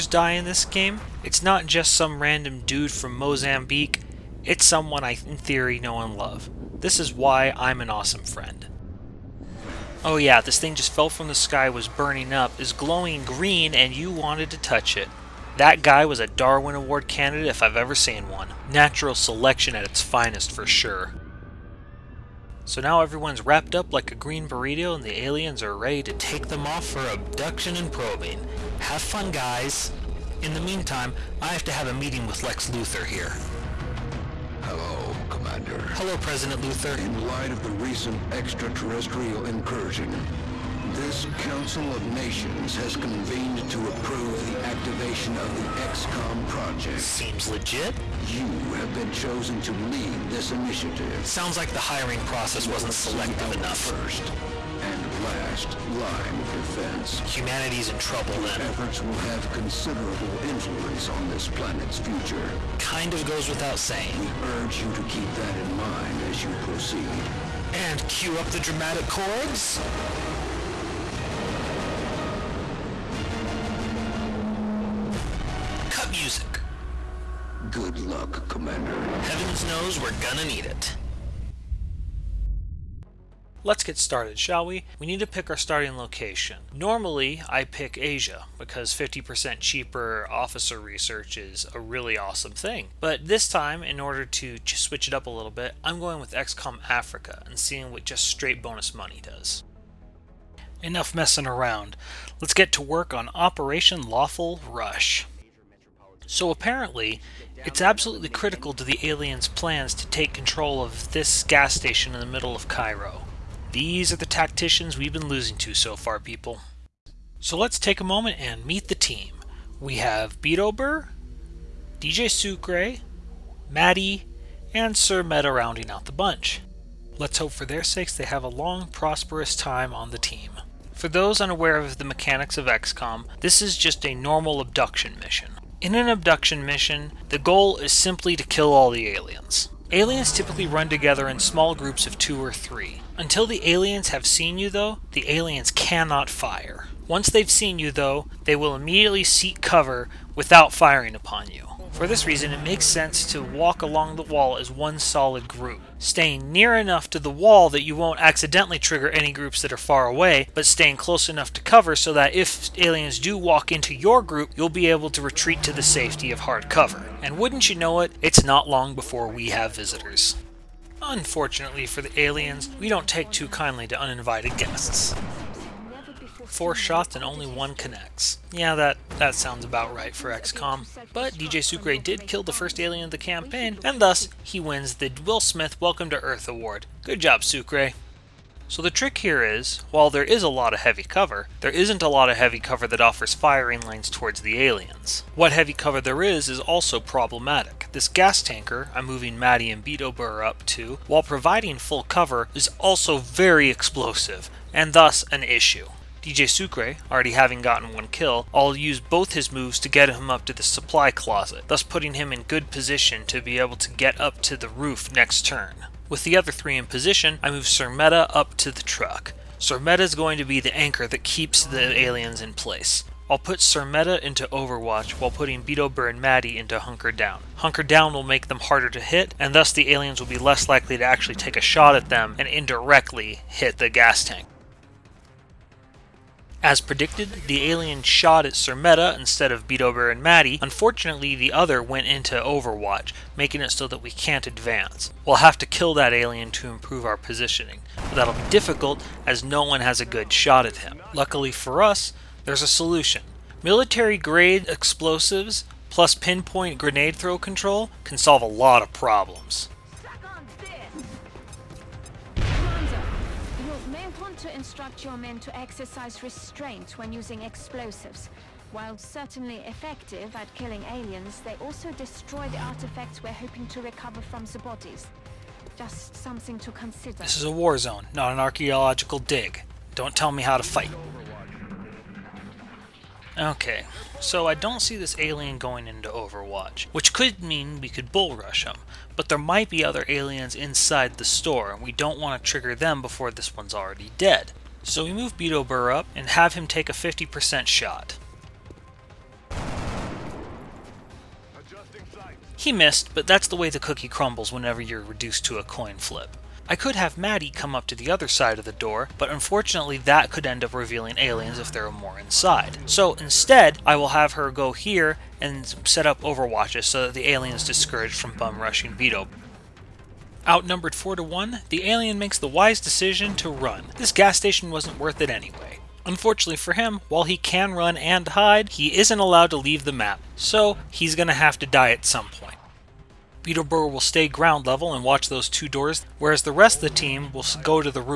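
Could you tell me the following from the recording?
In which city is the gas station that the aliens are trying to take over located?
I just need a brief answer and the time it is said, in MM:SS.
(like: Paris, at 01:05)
Cairo, at 01:52.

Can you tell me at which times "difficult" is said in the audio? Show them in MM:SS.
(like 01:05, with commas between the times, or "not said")
04:08.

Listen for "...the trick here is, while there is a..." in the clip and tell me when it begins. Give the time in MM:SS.
03:08.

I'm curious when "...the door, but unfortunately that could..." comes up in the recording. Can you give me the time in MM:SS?
05:08.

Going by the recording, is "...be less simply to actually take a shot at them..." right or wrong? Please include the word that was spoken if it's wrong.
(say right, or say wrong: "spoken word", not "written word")
wrong: "likely", not "simply".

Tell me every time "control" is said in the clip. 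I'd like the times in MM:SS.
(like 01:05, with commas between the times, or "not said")
01:50, 04:17.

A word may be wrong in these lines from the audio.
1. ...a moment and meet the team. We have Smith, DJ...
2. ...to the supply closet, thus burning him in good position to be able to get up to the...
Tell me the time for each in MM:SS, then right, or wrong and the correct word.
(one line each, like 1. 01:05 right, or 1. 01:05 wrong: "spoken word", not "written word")
1. 01:57 wrong: "Beetober", not "Smith"
2. 03:30 wrong: "putting", not "burning".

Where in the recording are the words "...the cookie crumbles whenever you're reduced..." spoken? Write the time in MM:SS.
05:03.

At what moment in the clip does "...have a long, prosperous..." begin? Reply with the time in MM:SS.
02:08.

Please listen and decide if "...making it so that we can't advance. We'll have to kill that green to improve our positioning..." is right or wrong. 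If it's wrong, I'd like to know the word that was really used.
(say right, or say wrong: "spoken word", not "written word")
wrong: "alien", not "green".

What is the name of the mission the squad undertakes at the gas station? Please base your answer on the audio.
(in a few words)
Operation Lawful Rush.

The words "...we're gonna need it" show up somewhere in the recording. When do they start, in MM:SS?
01:20.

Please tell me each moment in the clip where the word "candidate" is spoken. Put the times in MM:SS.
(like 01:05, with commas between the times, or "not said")
00:17.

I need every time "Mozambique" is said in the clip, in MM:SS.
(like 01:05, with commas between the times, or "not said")
00:03.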